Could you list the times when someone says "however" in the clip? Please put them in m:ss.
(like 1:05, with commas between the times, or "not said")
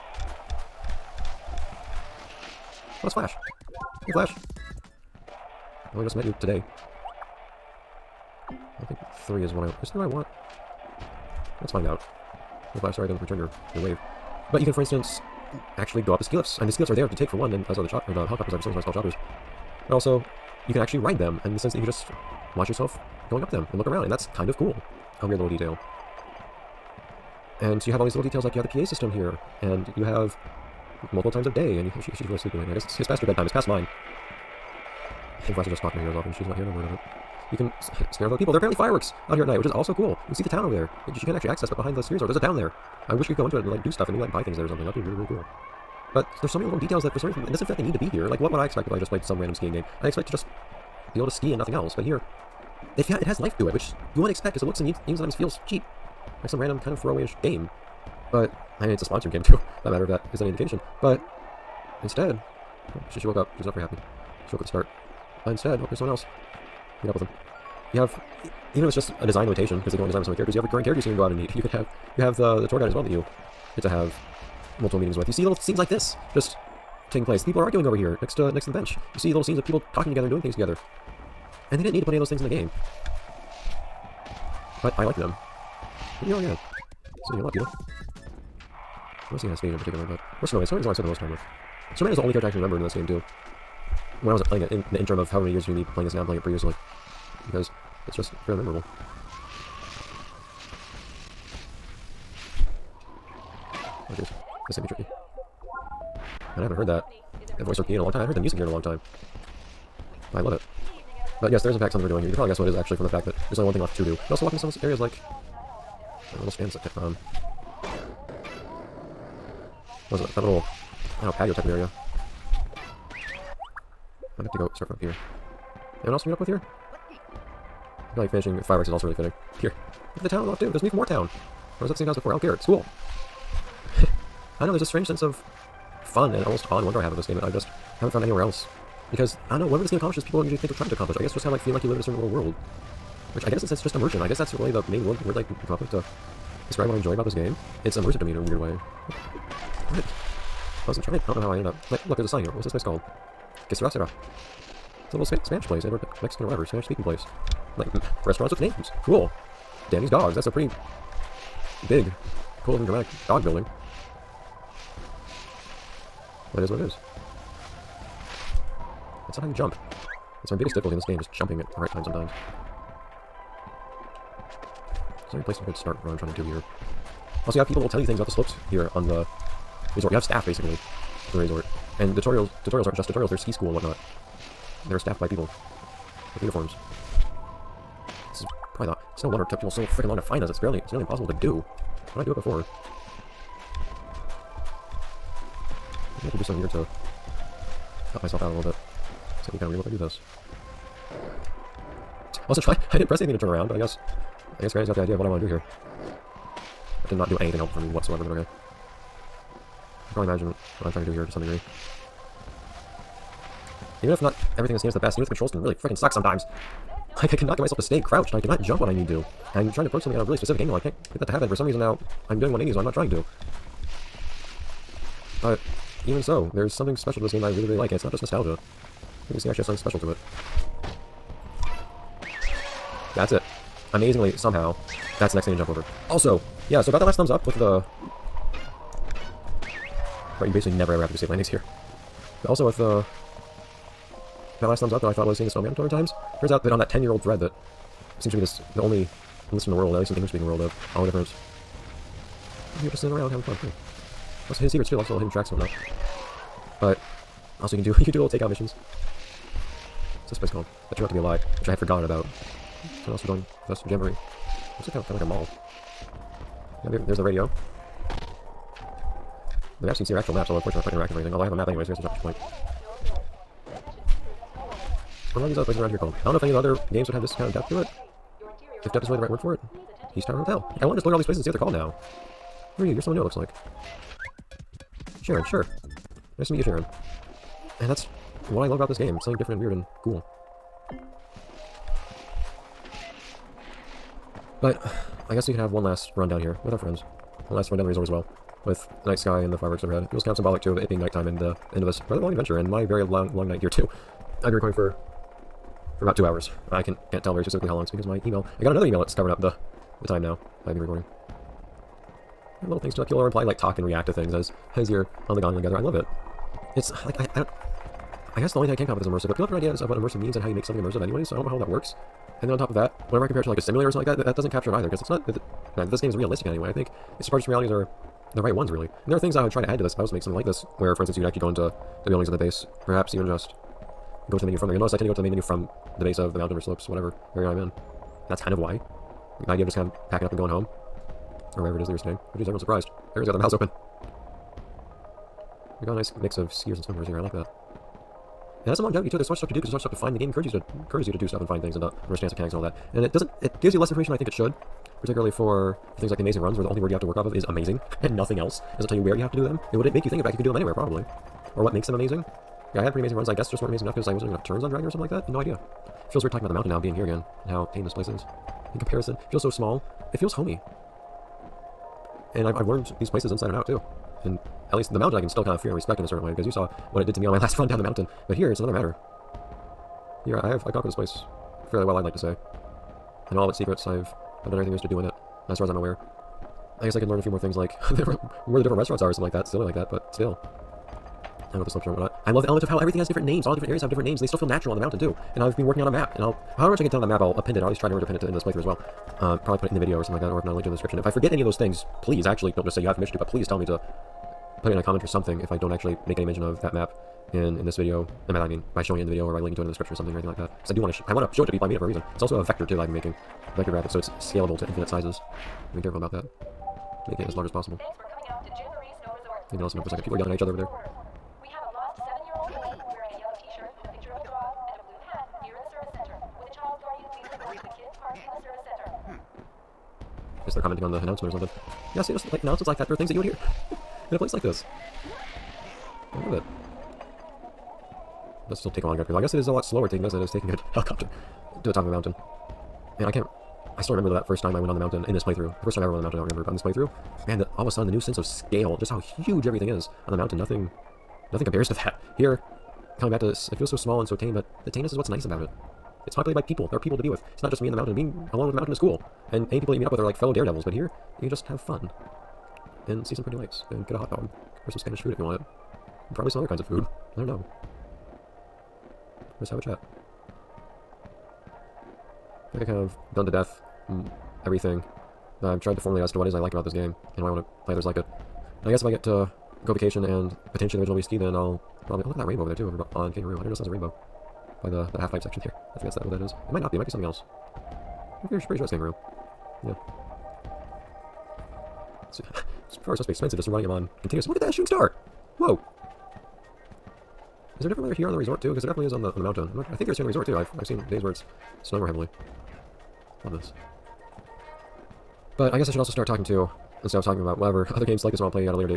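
1:35, 6:36.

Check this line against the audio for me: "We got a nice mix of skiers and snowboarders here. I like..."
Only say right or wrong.
right.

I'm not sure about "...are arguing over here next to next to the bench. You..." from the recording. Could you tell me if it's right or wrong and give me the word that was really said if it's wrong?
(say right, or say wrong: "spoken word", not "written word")
right.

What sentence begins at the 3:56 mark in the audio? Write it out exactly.
Also, yeah, so about that last thumbs up with the...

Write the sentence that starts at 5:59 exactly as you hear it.
It wouldn't make you think of back.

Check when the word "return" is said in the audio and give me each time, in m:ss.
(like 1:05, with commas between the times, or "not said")
0:13.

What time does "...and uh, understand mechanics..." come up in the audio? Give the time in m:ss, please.
5:51.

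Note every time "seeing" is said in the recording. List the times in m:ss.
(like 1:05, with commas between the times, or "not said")
1:29, 4:05.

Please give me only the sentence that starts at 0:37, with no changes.
You can scare with other people.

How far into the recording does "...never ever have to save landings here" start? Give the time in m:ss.
4:00.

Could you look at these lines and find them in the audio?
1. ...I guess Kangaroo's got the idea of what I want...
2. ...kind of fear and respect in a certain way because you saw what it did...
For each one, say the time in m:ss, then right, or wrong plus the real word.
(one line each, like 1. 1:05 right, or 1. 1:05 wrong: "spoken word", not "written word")
1. 3:24 wrong: "Granny", not "Kangaroo"
2. 6:15 right.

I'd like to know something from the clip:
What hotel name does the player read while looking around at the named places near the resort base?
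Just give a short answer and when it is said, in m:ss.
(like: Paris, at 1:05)
East Tower Hotel, at 4:40.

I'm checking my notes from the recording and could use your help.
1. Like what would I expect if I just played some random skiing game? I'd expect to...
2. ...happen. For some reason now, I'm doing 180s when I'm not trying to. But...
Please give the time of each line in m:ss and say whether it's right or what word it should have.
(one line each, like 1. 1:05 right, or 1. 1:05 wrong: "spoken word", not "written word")
1. 0:48 right
2. 3:41 right.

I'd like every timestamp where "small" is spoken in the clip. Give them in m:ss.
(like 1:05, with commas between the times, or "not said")
6:09, 7:33.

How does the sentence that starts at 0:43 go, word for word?
I wish you could go into it and like do stuff and maybe like buy things there or something.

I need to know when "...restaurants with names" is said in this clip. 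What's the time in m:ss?
2:38.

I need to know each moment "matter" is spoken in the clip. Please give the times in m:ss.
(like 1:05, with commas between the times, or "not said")
0:59, 6:18.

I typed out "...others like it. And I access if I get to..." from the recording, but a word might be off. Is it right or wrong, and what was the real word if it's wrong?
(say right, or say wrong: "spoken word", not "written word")
wrong: "guess", not "access".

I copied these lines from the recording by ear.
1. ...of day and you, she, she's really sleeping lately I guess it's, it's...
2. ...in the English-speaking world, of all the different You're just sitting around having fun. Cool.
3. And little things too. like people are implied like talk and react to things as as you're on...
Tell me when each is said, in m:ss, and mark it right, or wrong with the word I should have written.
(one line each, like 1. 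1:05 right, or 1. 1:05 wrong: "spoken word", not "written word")
1. 0:31 right
2. 4:10 right
3. 5:12 right.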